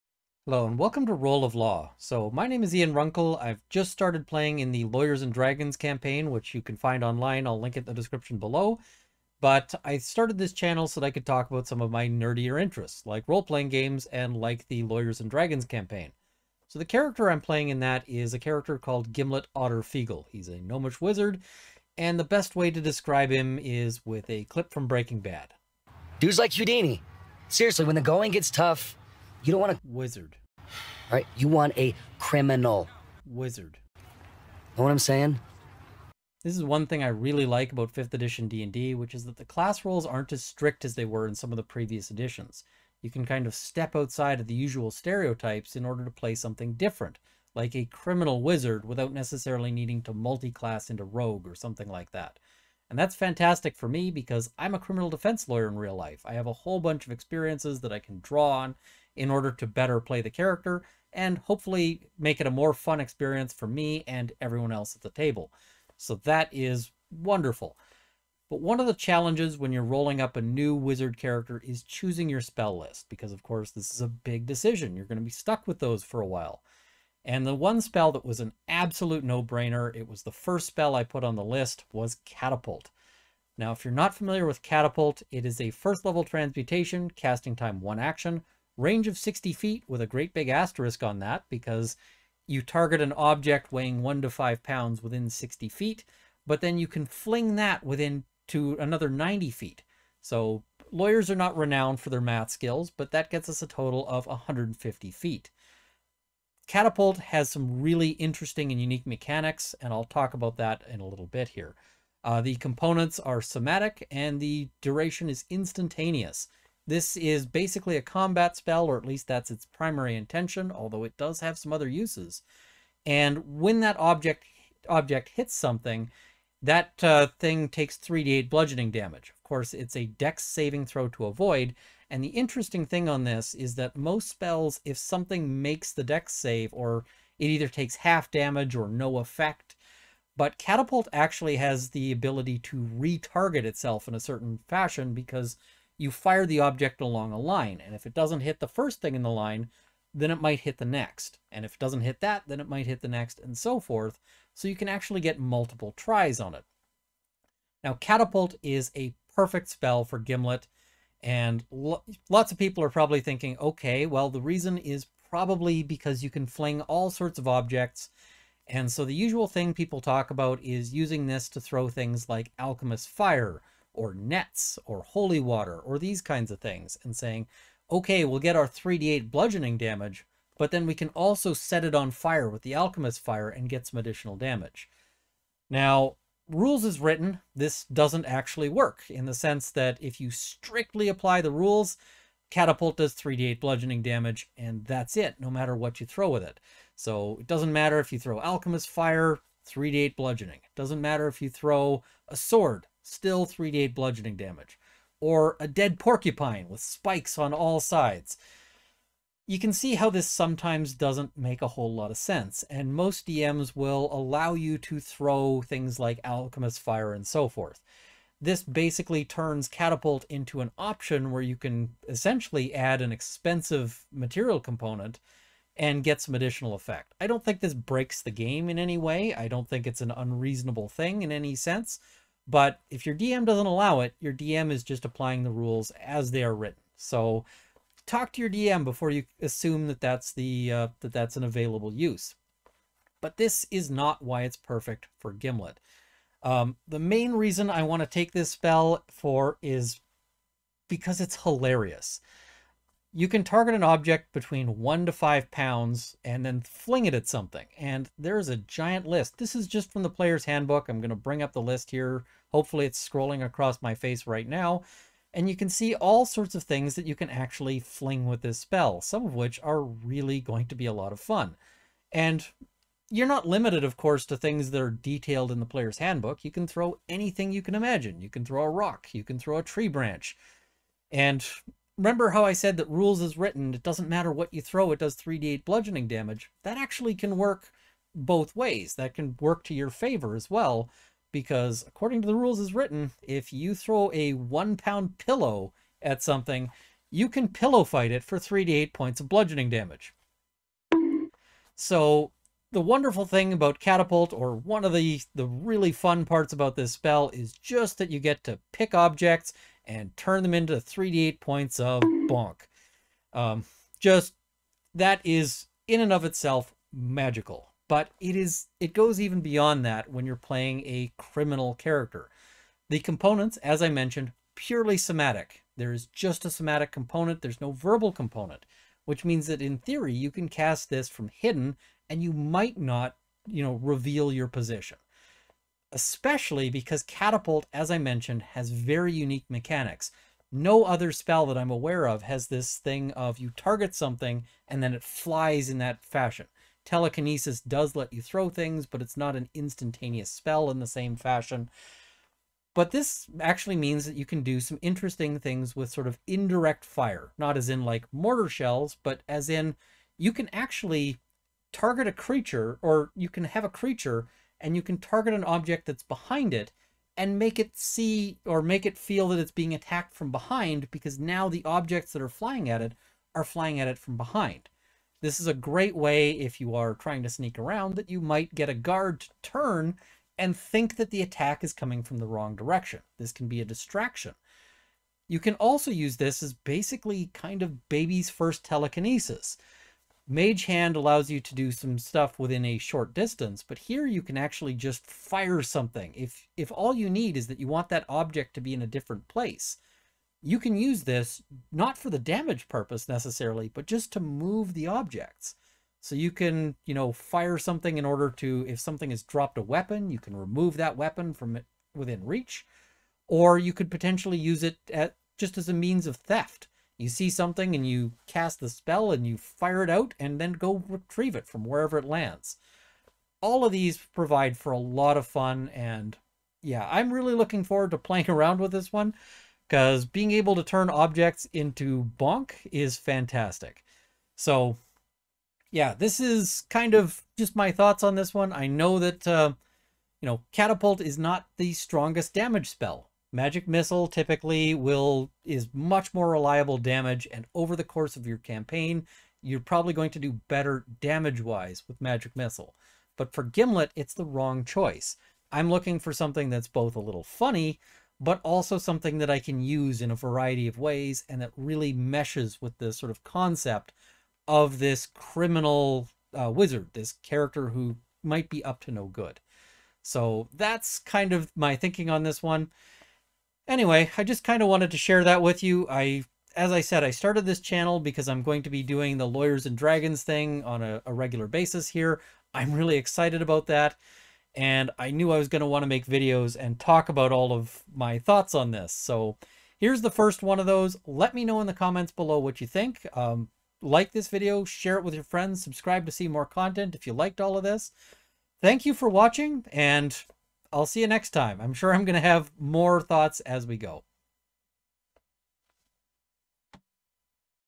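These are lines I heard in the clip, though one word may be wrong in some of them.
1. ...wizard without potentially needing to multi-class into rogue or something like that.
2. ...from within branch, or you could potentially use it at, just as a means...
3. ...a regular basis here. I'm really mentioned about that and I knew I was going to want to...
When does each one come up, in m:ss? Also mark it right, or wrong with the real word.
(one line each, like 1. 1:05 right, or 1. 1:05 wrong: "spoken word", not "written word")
1. 0:48 wrong: "necessarily", not "potentially"
2. 6:51 wrong: "reach", not "branch"
3. 8:01 wrong: "excited", not "mentioned".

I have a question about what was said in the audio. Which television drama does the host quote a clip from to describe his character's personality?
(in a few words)
Breaking Bad.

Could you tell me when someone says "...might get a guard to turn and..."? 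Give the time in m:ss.
6:18.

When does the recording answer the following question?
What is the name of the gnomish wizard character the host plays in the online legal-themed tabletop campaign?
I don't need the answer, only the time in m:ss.
0:19.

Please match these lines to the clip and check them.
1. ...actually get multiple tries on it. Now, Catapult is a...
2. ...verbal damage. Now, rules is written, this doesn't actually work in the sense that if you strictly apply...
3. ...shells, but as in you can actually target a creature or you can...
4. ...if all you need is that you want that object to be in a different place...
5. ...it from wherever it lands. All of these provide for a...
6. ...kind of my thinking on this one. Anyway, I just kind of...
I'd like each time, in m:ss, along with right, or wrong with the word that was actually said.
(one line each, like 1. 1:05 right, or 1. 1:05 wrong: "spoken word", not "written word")
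1. 2:34 right
2. 3:03 wrong: "additional", not "verbal"
3. 5:58 right
4. 6:36 right
5. 7:01 right
6. 7:50 right.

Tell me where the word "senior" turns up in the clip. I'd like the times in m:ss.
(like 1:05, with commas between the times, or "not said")
not said.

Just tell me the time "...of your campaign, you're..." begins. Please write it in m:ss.
7:28.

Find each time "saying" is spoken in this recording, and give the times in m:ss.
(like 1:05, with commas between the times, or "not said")
0:34, 2:57.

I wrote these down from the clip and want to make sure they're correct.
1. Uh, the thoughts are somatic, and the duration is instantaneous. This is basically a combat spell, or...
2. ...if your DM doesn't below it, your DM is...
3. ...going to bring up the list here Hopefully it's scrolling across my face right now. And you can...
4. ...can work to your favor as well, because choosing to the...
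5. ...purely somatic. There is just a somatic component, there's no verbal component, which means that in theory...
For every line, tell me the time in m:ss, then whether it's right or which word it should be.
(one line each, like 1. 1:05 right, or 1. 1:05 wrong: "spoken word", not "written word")
1. 1:52 wrong: "components", not "thoughts"
2. 3:52 wrong: "allow", not "below"
3. 4:21 right
4. 4:49 wrong: "according", not "choosing"
5. 5:24 right.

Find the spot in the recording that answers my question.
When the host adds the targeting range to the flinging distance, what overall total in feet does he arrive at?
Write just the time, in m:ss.
1:44.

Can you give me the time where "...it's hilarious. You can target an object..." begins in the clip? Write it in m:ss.
4:11.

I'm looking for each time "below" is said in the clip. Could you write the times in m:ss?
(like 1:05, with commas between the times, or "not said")
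0:08, 8:12.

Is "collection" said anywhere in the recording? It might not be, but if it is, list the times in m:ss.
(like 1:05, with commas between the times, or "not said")
not said.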